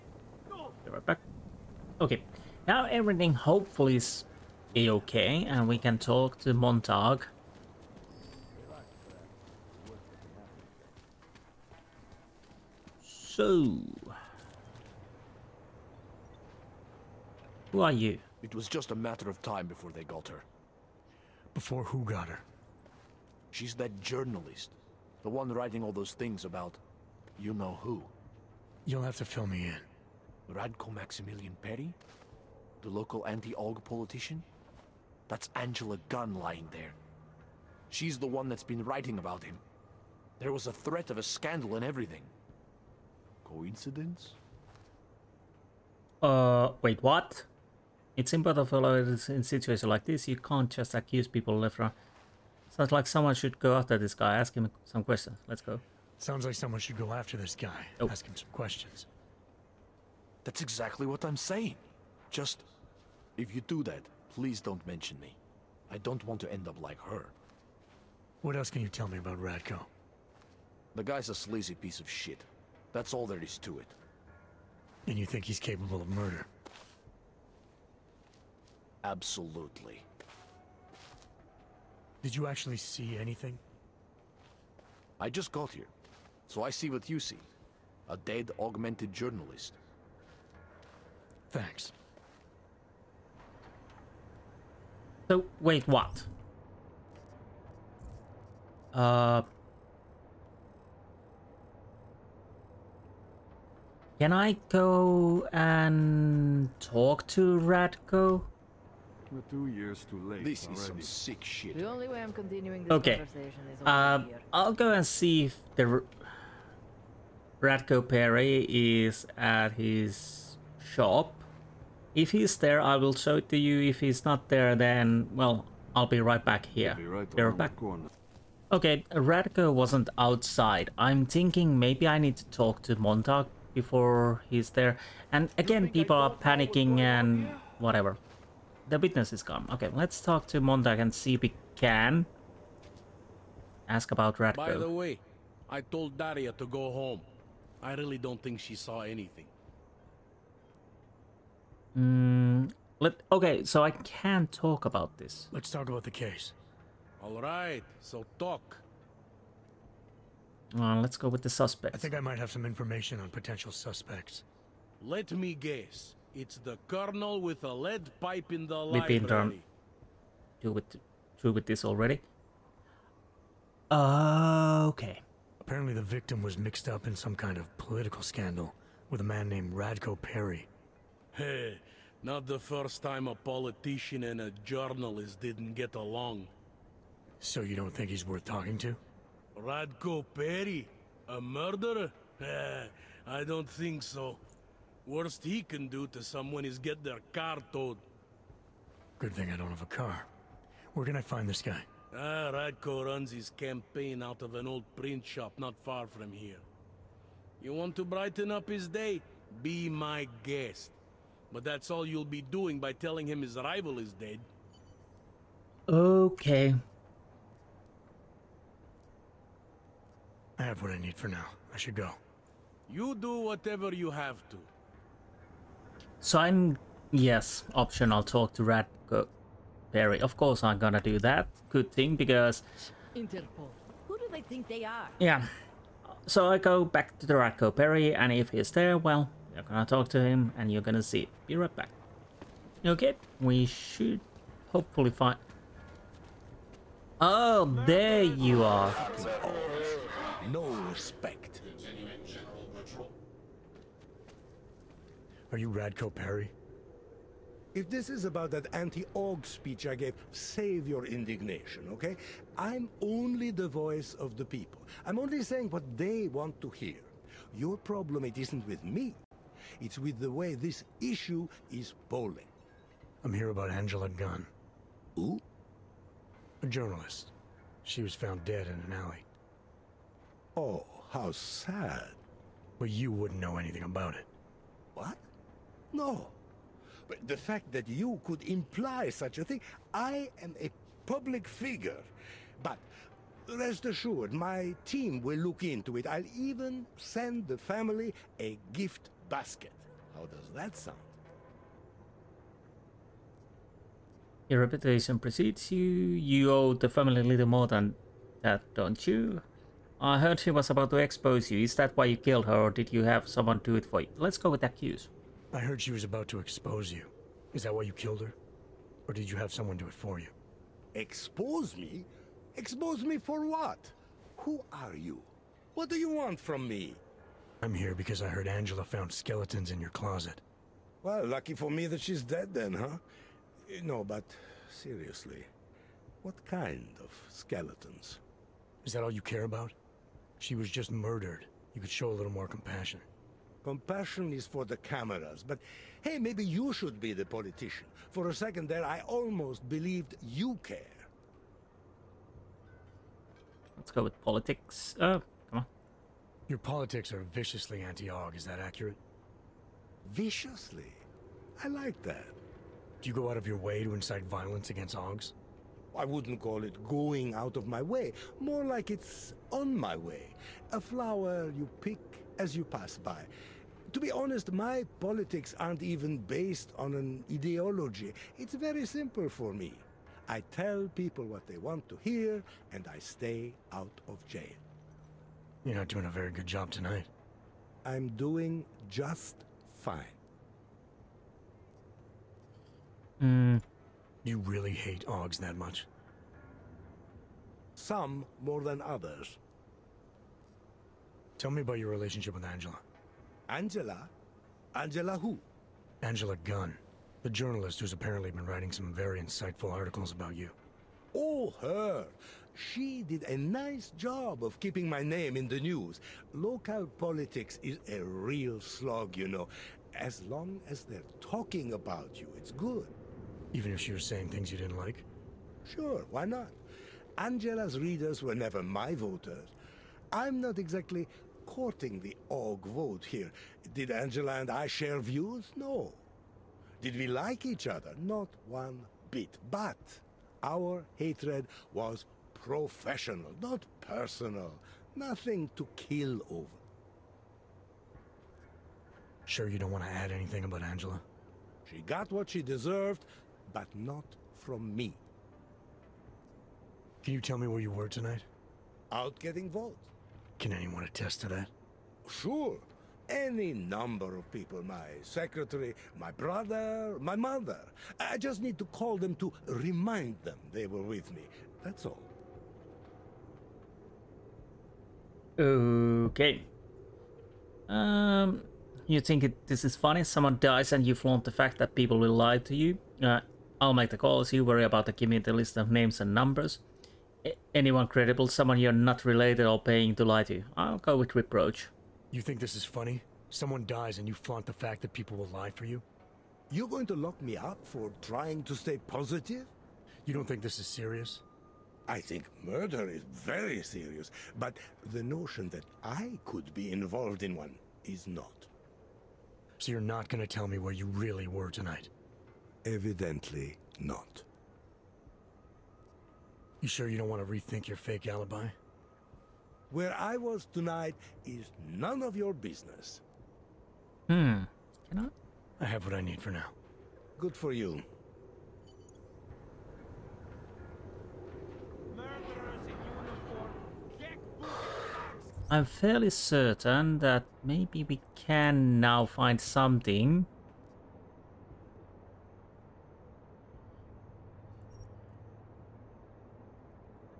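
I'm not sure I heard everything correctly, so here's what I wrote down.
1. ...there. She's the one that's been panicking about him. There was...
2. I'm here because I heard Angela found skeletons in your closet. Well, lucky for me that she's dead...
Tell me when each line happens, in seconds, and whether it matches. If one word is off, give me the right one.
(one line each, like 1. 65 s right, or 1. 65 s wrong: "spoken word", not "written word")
1. 36 s wrong: "writing", not "panicking"
2. 327 s right.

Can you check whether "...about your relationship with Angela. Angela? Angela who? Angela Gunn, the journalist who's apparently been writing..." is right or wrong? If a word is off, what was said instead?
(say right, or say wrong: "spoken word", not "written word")
right.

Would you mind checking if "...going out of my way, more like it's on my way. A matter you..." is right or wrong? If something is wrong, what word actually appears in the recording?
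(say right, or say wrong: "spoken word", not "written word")
wrong: "flower", not "matter".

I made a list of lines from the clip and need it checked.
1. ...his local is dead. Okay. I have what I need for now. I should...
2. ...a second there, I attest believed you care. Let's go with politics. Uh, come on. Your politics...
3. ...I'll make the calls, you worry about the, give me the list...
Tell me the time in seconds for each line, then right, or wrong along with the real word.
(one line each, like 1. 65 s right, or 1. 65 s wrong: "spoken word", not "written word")
1. 213 s wrong: "rival", not "local"
2. 348 s wrong: "almost", not "attest"
3. 483 s right.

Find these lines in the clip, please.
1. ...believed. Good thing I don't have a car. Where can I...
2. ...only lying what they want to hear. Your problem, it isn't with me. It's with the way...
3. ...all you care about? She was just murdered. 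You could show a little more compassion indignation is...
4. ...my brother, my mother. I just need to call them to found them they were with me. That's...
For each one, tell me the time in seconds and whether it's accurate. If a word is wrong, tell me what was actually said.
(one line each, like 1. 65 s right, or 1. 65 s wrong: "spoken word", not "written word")
1. 197 s wrong: "towed", not "believed"
2. 265 s wrong: "saying", not "lying"
3. 339 s wrong: "compassion", not "indignation"
4. 465 s wrong: "remind", not "found".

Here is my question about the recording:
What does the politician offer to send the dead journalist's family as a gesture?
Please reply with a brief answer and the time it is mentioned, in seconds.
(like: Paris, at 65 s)
a gift basket, at 298 s.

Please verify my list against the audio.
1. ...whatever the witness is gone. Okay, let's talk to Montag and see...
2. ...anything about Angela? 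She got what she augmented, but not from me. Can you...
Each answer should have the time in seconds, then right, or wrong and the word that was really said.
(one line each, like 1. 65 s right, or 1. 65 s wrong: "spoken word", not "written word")
1. 137 s right
2. 450 s wrong: "deserved", not "augmented".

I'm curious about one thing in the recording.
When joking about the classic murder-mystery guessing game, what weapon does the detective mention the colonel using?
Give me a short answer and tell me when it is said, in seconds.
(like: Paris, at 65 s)
a lead pipe, at 167 s.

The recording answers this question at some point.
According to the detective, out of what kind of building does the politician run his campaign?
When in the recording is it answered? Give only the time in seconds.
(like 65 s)
204 s.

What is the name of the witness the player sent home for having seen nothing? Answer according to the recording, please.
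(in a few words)
Daria.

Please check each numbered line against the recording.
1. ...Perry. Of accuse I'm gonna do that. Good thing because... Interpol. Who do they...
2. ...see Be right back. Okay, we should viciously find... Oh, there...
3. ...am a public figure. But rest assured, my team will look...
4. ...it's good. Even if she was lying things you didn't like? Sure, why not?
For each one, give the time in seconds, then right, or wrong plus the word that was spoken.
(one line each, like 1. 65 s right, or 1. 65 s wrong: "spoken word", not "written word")
1. 229 s wrong: "course", not "accuse"
2. 241 s wrong: "hopefully", not "viciously"
3. 290 s right
4. 422 s wrong: "saying", not "lying".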